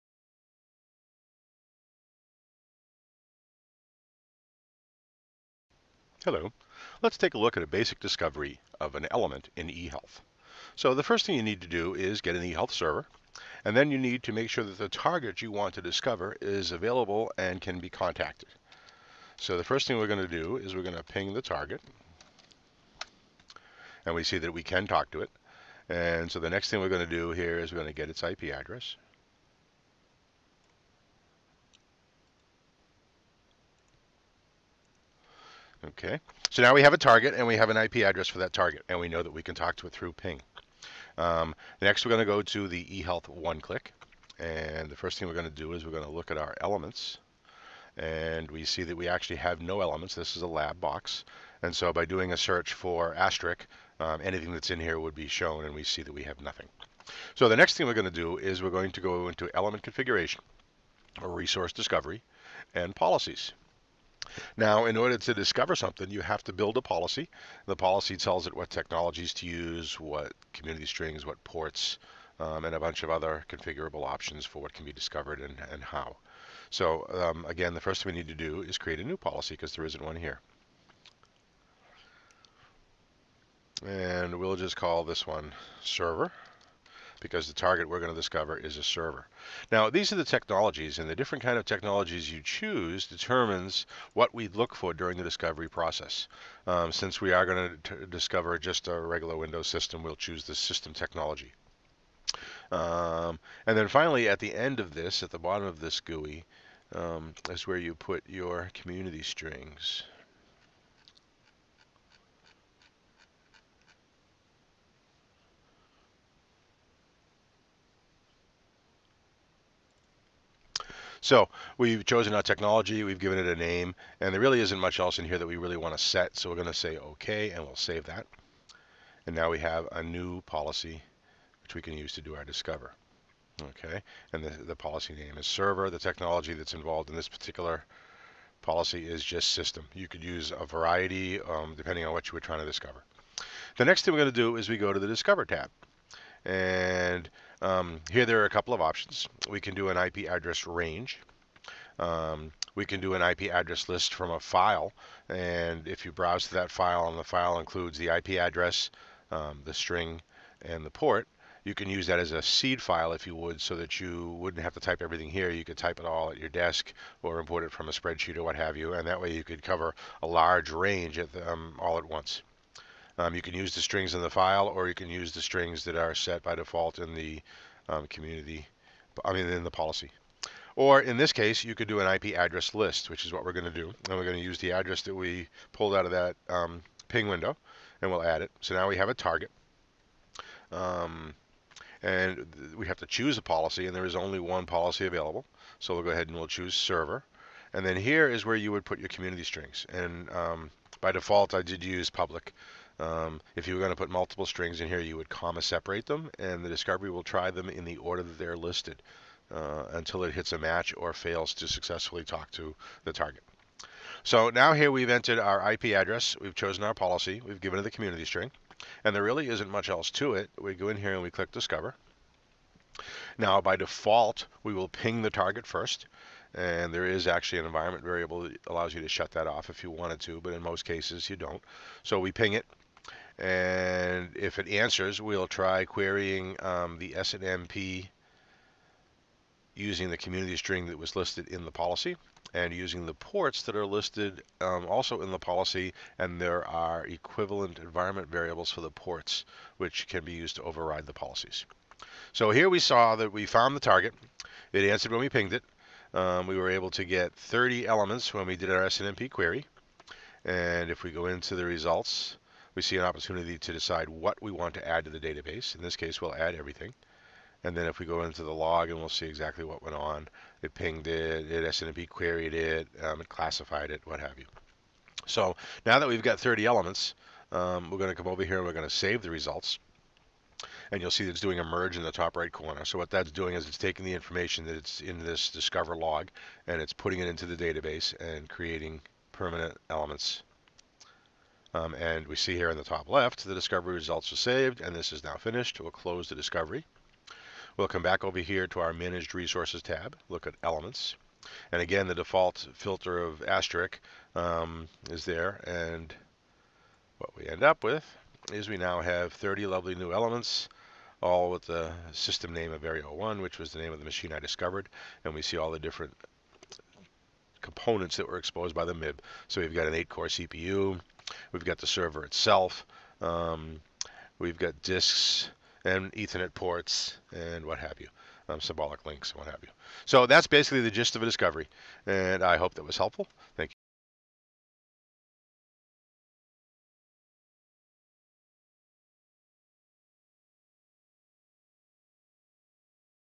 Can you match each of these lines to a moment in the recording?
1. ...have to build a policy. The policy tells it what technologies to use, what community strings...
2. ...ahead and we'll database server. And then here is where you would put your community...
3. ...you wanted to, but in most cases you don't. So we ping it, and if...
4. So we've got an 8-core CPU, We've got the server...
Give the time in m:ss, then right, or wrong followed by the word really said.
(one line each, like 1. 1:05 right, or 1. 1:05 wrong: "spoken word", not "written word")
1. 1:06 right
2. 3:16 wrong: "choose", not "database"
3. 3:49 right
4. 5:19 right.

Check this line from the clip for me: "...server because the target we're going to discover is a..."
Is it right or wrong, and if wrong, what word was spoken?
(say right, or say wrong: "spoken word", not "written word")
right.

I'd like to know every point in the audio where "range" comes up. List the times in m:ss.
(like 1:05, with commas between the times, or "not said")
2:30, 2:50.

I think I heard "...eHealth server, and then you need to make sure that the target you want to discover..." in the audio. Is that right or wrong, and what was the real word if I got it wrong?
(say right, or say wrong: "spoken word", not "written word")
right.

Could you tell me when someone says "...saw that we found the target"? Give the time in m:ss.
4:12.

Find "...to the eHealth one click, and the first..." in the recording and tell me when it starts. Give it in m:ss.
0:42.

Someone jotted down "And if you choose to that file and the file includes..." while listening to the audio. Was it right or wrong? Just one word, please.
wrong.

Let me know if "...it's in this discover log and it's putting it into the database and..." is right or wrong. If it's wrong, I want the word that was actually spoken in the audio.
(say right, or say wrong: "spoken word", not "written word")
right.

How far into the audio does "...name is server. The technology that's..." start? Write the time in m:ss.
2:15.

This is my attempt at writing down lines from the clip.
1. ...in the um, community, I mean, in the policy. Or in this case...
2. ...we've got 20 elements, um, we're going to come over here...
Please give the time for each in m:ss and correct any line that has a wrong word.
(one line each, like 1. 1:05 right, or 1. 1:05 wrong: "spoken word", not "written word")
1. 2:56 right
2. 4:36 wrong: "30", not "20".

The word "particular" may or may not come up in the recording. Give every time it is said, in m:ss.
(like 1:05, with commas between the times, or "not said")
2:17.